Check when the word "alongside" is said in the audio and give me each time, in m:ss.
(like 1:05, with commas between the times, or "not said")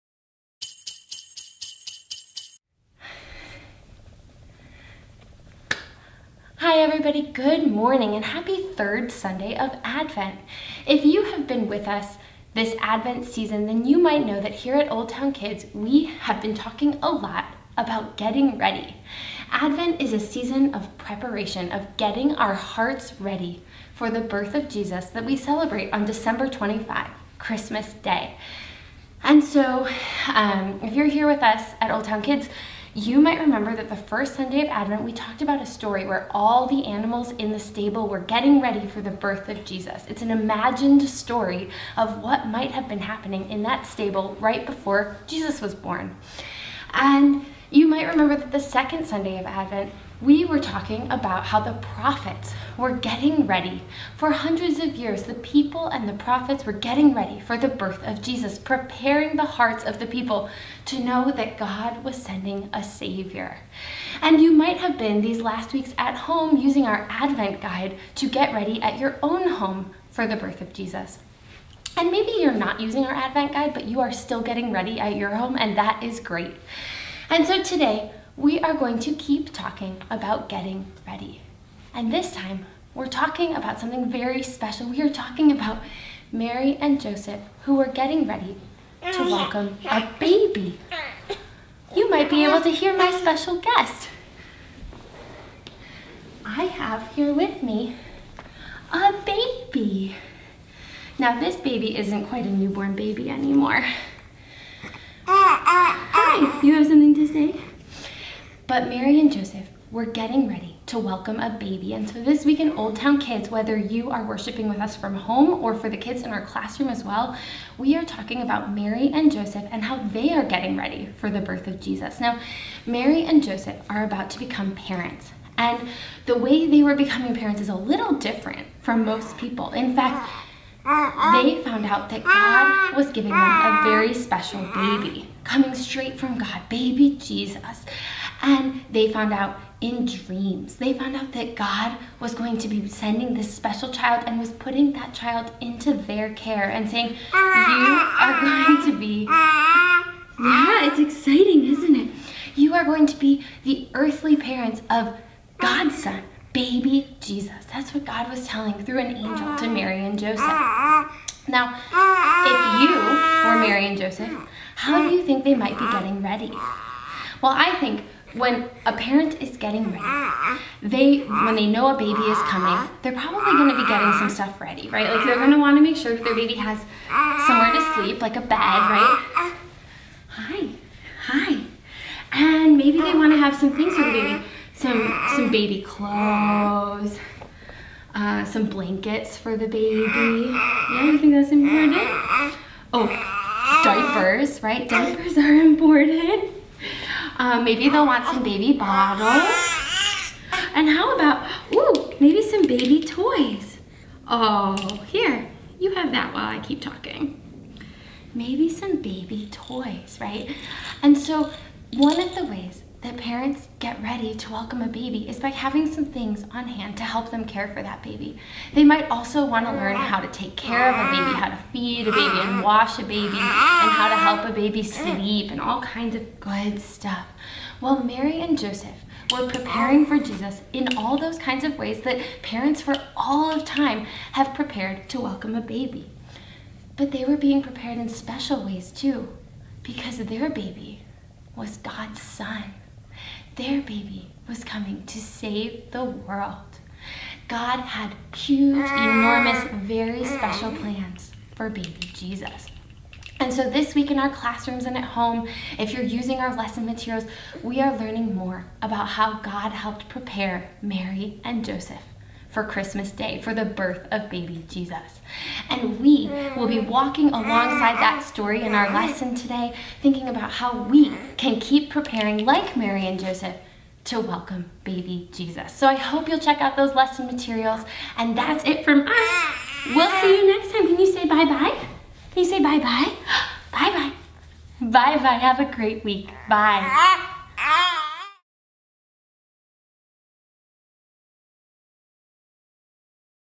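4:27.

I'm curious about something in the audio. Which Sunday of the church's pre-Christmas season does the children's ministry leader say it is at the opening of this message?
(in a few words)
Third Sunday of Advent.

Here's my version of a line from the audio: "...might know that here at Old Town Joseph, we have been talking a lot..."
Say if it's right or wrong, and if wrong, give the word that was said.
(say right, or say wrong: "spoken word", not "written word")
wrong: "Kids", not "Joseph".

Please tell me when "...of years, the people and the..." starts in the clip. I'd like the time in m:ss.
0:54.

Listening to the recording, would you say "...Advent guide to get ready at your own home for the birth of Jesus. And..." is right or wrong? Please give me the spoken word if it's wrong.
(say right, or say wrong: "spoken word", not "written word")
right.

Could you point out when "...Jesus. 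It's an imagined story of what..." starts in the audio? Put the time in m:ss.
0:39.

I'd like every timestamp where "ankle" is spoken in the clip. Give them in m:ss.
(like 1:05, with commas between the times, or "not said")
not said.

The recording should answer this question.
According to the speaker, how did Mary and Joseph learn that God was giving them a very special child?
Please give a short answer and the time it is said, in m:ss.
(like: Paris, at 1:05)
In dreams, at 2:19.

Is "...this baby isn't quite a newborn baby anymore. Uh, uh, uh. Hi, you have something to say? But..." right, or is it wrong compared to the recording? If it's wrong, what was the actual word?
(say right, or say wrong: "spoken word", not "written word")
right.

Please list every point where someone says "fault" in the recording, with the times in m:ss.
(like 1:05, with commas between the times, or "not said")
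not said.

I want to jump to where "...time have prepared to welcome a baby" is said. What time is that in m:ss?
3:53.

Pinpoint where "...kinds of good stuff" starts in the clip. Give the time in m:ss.
3:45.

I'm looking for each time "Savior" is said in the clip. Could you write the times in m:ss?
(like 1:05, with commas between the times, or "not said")
1:02.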